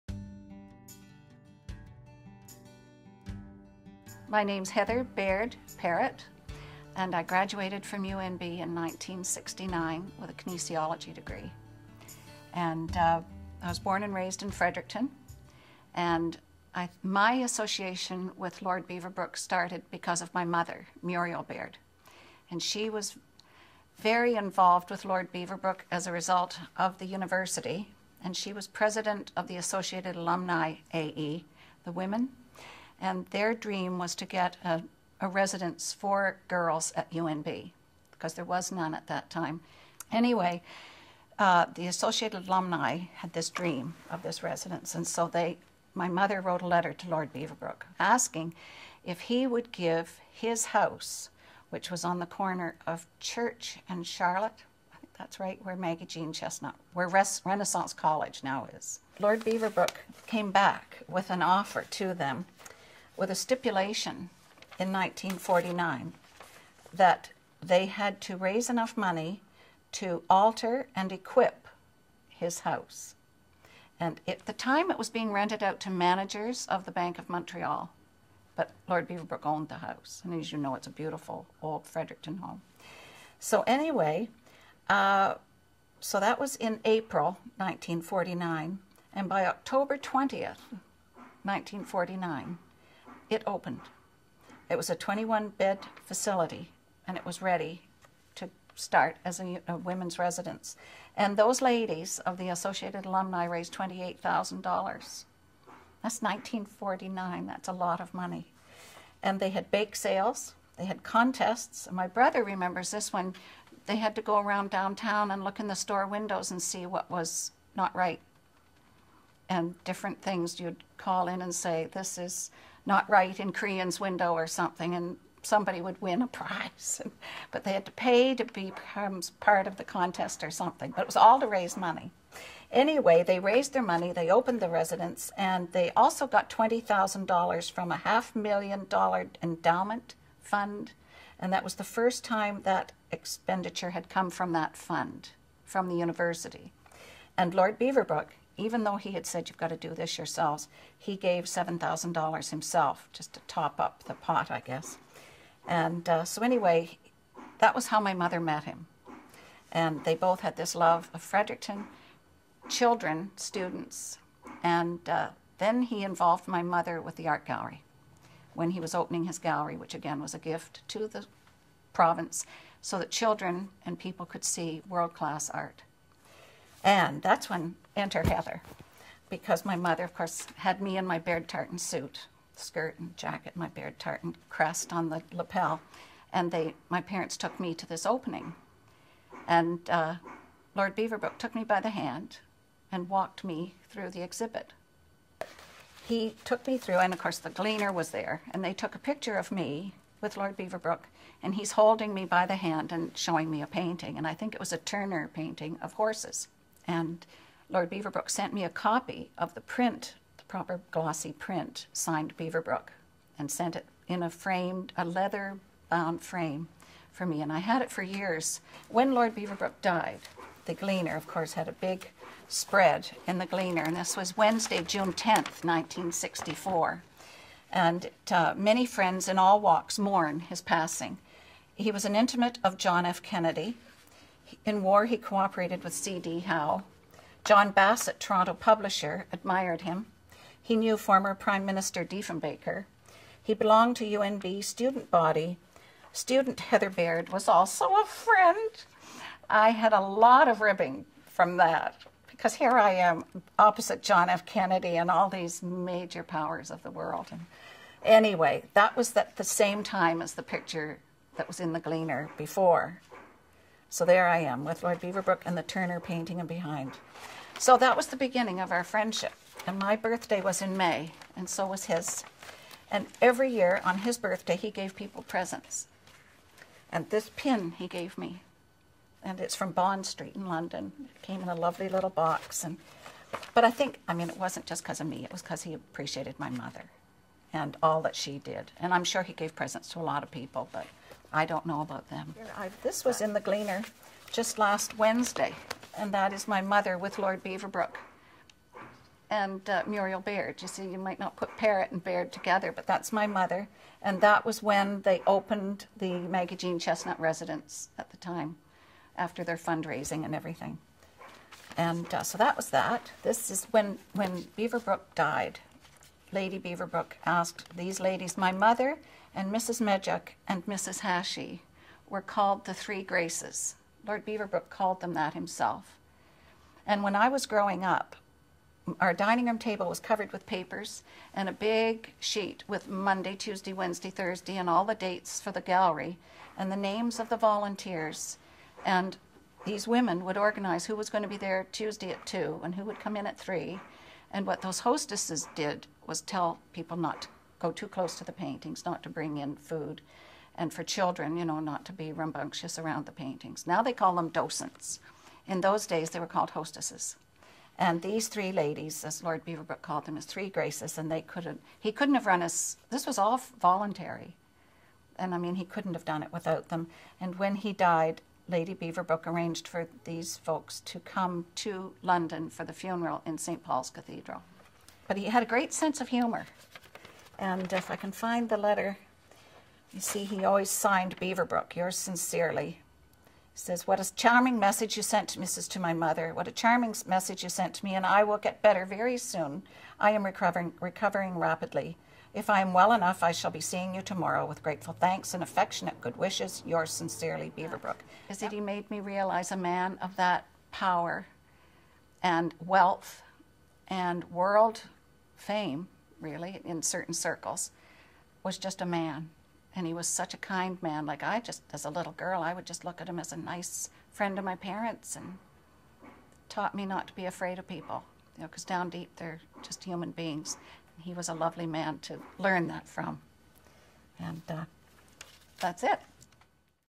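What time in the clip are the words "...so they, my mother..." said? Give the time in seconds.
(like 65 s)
45 s.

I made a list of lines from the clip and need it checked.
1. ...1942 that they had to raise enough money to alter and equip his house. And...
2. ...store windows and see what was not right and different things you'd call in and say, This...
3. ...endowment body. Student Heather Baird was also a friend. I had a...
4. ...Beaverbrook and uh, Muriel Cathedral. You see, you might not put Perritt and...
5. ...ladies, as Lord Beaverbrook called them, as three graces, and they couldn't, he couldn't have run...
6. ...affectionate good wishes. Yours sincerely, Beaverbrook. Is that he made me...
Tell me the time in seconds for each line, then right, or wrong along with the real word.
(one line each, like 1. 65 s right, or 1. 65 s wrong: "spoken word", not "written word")
1. 64 s wrong: "1949", not "1942"
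2. 115 s right
3. 244 s wrong: "student", not "endowment"
4. 297 s wrong: "Baird", not "Cathedral"
5. 358 s right
6. 395 s right.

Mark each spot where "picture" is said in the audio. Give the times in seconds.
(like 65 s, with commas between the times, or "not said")
198 s, 260 s.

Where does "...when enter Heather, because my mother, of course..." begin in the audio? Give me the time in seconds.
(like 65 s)
177 s.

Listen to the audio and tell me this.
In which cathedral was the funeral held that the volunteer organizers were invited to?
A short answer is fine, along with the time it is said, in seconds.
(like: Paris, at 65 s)
St. Paul's Cathedral, at 373 s.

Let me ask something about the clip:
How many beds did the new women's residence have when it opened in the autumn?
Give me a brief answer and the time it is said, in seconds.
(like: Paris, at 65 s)
21, at 94 s.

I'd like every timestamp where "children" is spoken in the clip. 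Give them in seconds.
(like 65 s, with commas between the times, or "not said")
162 s, 173 s, 350 s.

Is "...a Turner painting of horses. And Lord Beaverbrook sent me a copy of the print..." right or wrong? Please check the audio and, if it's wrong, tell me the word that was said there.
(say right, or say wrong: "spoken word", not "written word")
right.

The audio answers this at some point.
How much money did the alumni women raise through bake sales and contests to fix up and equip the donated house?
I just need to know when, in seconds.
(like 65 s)
103 s.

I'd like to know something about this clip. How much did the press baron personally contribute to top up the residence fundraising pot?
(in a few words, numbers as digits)
$7,000.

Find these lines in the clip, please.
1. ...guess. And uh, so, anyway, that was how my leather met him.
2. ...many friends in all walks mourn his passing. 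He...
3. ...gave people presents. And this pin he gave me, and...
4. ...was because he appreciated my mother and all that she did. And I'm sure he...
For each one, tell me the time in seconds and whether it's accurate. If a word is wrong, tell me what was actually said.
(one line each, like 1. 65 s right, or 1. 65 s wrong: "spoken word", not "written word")
1. 154 s wrong: "mother", not "leather"
2. 228 s right
3. 274 s right
4. 285 s right.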